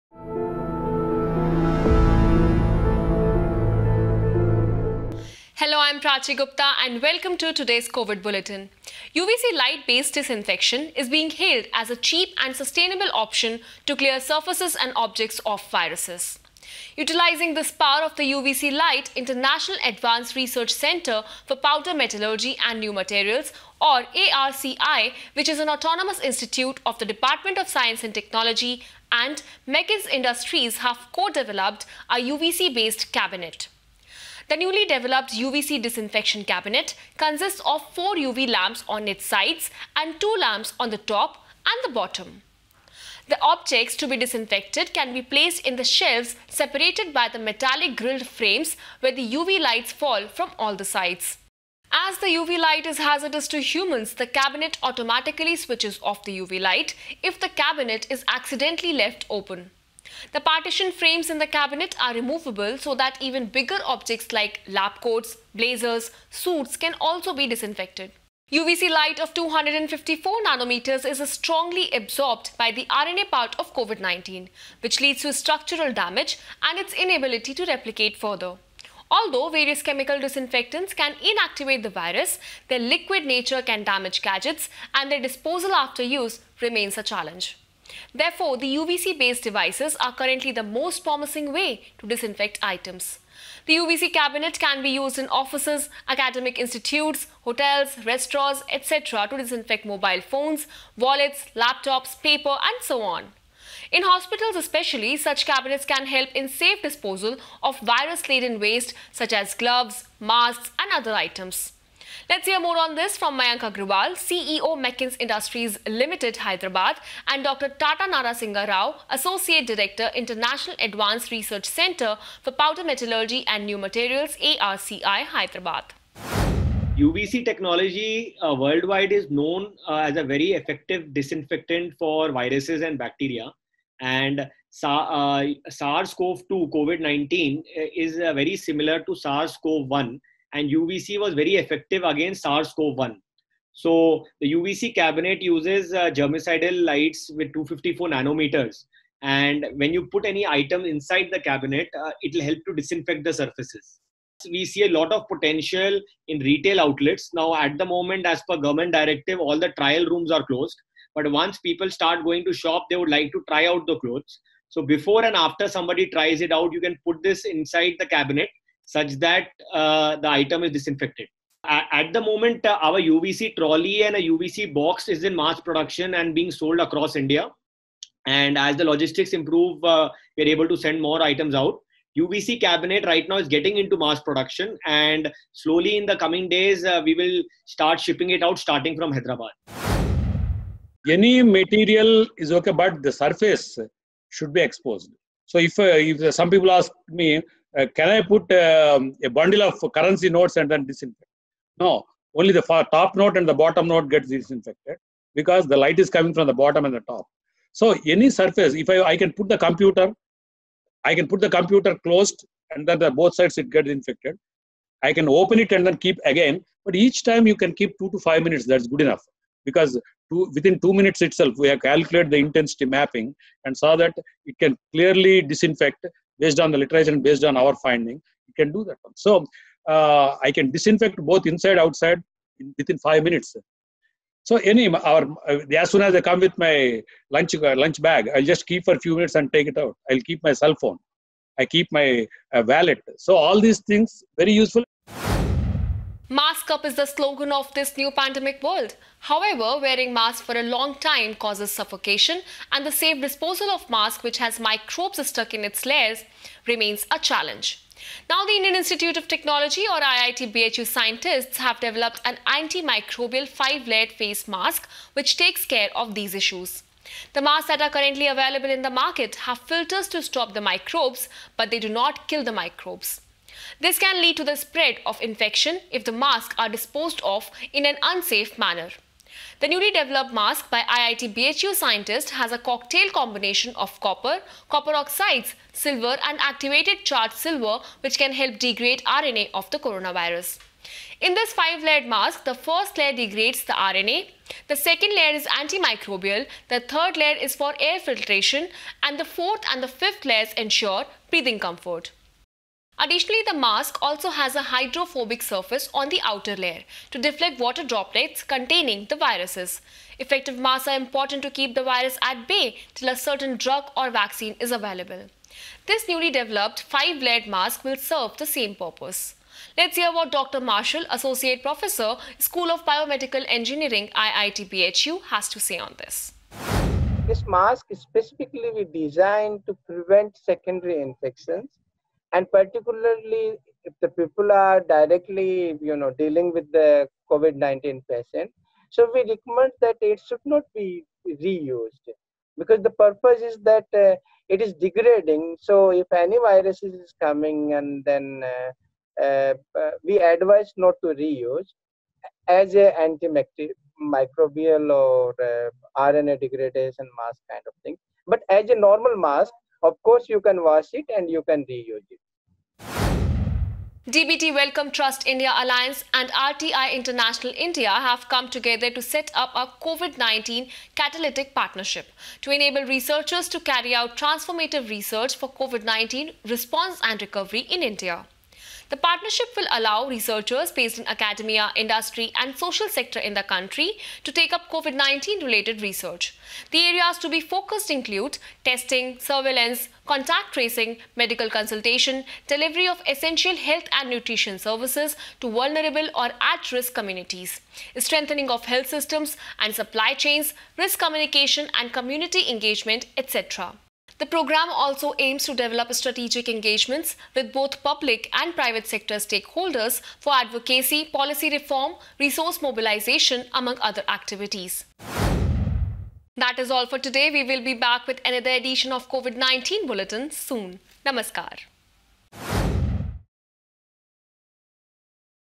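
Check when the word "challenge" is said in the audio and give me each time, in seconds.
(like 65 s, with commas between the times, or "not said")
87 s, 257 s.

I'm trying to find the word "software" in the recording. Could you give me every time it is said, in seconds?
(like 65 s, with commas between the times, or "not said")
not said.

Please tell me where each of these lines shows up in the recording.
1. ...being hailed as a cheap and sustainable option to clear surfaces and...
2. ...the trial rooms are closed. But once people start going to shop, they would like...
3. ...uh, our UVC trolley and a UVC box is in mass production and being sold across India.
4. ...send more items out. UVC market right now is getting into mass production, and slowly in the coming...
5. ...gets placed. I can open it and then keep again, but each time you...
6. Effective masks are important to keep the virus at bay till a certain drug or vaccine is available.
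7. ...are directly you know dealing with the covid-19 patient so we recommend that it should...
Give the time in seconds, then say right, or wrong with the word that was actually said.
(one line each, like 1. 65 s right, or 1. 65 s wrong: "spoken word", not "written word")
1. 11 s right
2. 159 s right
3. 172 s right
4. 180 s wrong: "cabinet", not "market"
5. 213 s wrong: "infected", not "placed"
6. 310 s right
7. 334 s right.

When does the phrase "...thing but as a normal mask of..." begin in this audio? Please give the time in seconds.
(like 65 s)
357 s.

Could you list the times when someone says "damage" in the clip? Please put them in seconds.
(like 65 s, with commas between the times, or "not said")
75 s, 83 s.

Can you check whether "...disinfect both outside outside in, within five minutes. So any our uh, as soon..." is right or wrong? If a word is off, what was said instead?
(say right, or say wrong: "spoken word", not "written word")
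wrong: "inside", not "outside".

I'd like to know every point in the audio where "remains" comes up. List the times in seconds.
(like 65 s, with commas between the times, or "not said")
86 s, 256 s.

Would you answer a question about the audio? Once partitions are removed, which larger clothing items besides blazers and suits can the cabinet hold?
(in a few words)
Lab coats.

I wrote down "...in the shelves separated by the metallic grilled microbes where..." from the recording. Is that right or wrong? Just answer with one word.
wrong.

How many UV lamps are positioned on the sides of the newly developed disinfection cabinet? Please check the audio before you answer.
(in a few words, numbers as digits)
4.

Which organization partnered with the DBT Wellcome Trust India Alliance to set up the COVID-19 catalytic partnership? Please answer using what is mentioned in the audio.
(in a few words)
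RTI International India.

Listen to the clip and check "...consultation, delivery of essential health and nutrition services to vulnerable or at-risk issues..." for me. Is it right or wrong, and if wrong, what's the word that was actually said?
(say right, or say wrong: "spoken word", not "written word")
wrong: "communities", not "issues".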